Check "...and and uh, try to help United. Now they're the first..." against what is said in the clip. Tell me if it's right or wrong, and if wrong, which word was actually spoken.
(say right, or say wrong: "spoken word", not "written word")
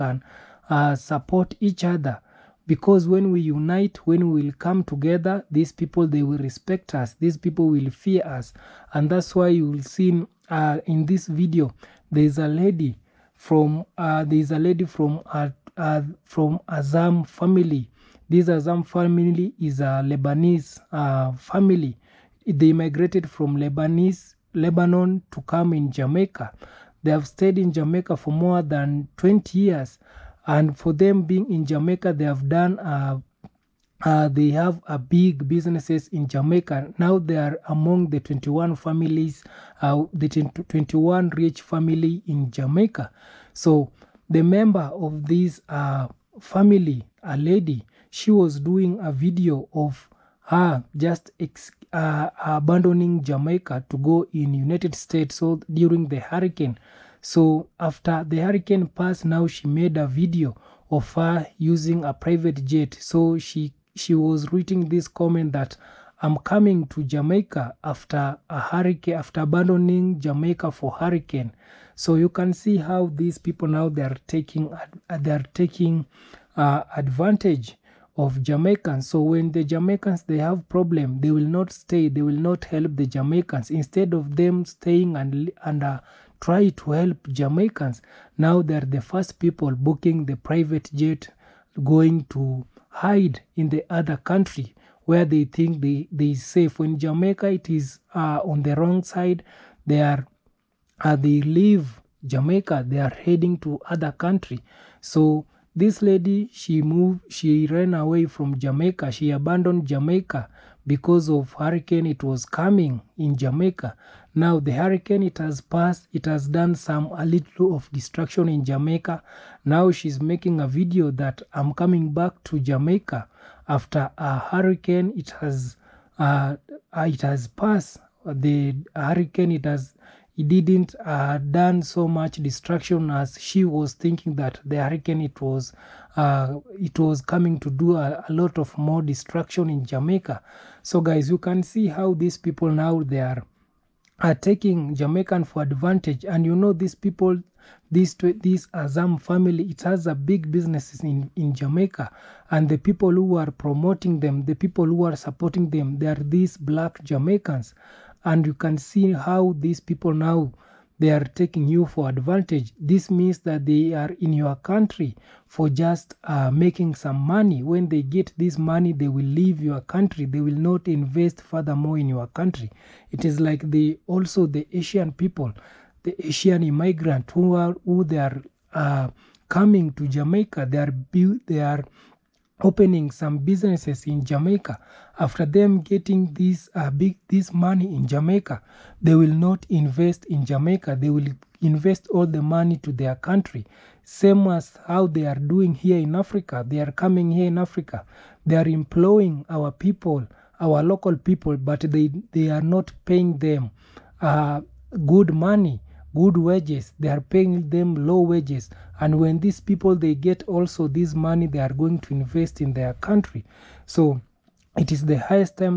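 wrong: "Jamaicans", not "United".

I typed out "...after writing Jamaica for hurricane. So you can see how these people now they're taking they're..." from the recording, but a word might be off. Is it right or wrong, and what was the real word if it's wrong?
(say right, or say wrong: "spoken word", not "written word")
wrong: "abandoning", not "writing".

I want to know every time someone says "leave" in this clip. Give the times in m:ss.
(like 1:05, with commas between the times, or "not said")
1:41, 2:49.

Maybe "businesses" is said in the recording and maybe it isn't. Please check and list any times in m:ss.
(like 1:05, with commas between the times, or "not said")
0:35, 2:30, 3:03.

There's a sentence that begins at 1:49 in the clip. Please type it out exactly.
She abandoned Jamaica because of hurricane it was coming in Jamaica.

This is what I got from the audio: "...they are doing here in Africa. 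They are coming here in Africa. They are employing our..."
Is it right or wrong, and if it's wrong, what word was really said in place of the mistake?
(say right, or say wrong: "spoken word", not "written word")
right.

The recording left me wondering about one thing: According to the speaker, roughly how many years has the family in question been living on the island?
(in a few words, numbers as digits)
More than 20 years.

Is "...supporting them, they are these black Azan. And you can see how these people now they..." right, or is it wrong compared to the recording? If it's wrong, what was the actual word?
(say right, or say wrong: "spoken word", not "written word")
wrong: "Jamaicans", not "Azan".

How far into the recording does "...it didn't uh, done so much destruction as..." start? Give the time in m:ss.
2:10.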